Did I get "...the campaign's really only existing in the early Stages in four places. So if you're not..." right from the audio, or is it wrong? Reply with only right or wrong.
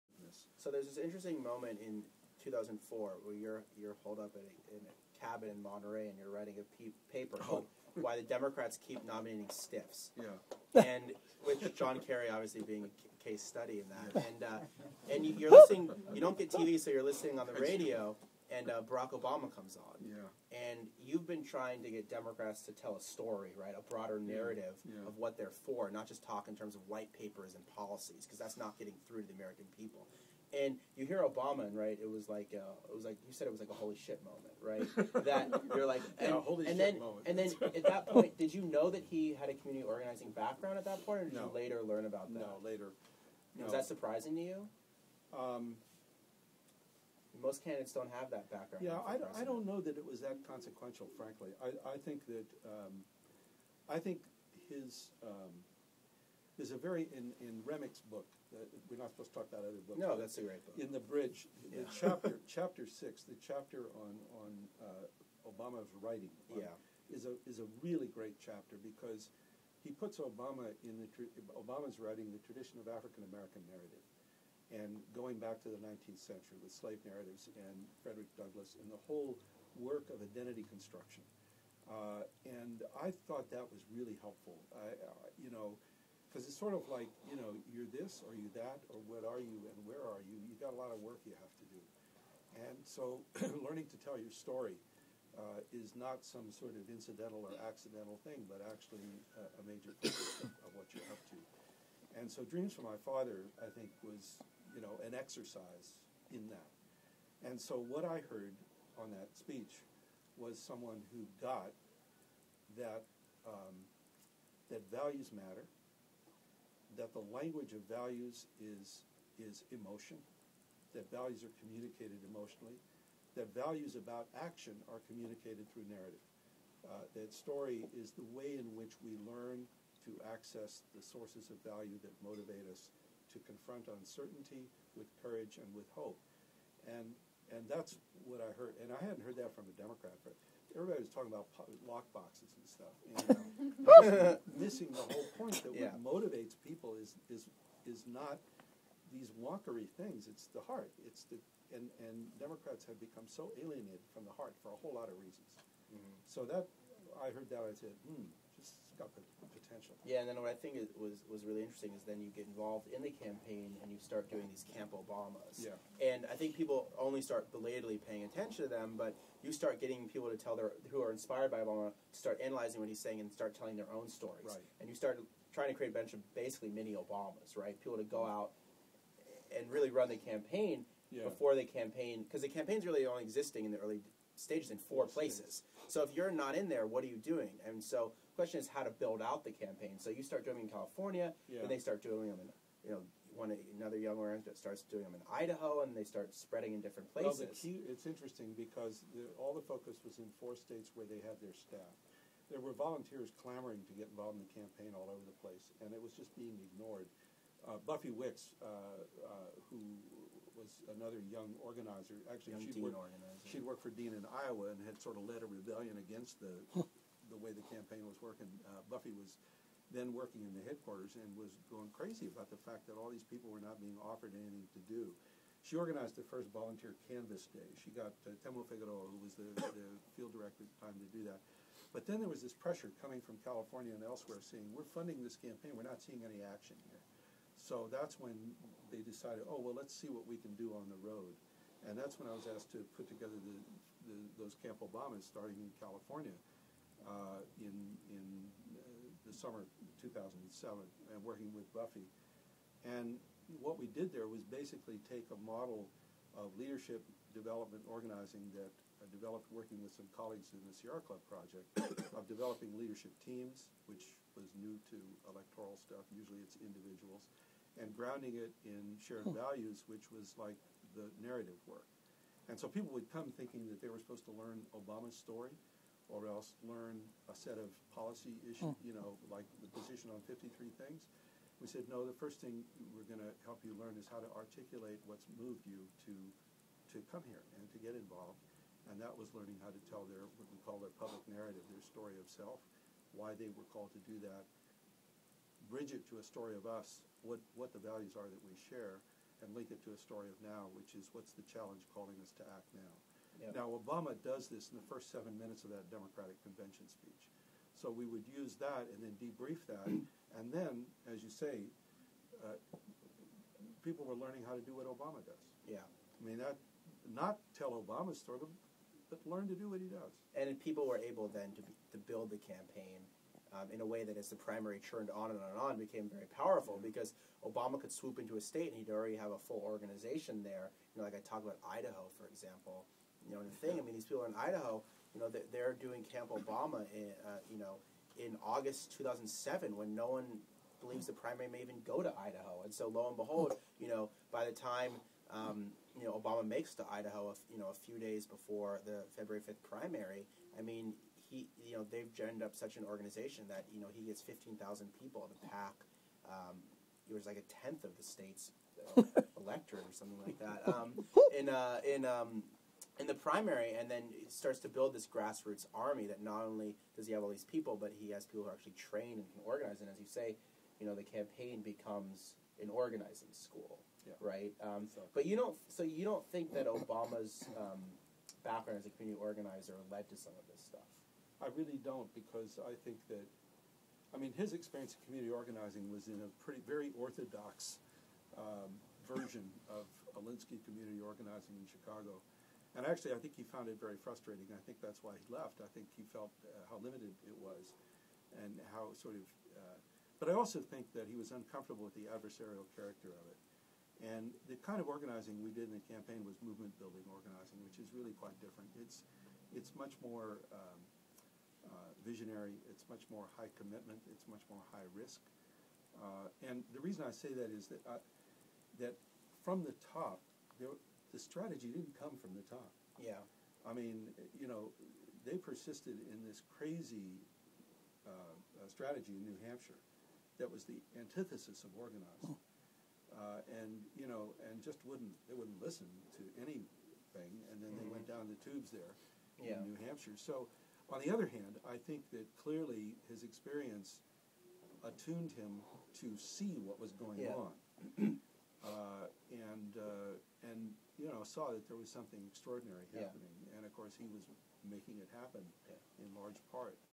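right.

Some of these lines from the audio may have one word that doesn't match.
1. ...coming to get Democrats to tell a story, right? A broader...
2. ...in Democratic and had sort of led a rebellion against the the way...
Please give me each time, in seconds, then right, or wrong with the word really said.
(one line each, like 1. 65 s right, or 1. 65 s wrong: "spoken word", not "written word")
1. 21 s wrong: "trying", not "coming"
2. 214 s wrong: "Iowa", not "Democratic".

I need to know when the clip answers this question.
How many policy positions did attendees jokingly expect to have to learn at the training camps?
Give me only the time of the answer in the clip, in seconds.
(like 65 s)
280 s.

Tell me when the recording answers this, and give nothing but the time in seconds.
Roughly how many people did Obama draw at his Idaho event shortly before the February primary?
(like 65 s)
354 s.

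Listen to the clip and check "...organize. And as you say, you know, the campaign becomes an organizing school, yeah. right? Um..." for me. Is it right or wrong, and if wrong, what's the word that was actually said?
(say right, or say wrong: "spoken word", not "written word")
right.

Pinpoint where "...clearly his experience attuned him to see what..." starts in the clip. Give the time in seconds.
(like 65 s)
442 s.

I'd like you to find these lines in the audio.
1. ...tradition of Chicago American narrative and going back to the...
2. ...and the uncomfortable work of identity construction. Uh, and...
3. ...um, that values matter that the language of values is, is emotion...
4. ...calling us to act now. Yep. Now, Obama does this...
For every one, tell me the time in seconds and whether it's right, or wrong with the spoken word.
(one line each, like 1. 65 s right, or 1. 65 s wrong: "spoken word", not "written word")
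1. 72 s wrong: "African", not "Chicago"
2. 78 s wrong: "whole", not "uncomfortable"
3. 113 s right
4. 301 s right.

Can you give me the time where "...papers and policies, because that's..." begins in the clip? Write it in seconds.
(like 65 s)
27 s.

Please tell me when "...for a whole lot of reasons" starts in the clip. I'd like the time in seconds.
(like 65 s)
154 s.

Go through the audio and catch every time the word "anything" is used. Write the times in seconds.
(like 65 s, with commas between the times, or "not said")
224 s, 436 s.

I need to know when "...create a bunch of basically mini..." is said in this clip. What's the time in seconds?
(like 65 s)
175 s.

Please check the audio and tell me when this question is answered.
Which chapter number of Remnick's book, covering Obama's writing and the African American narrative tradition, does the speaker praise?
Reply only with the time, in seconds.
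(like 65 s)
62 s.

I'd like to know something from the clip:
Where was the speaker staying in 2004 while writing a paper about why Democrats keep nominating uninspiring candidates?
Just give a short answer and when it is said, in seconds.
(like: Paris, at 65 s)
Monterey, at 5 s.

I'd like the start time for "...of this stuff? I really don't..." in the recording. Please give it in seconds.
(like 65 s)
380 s.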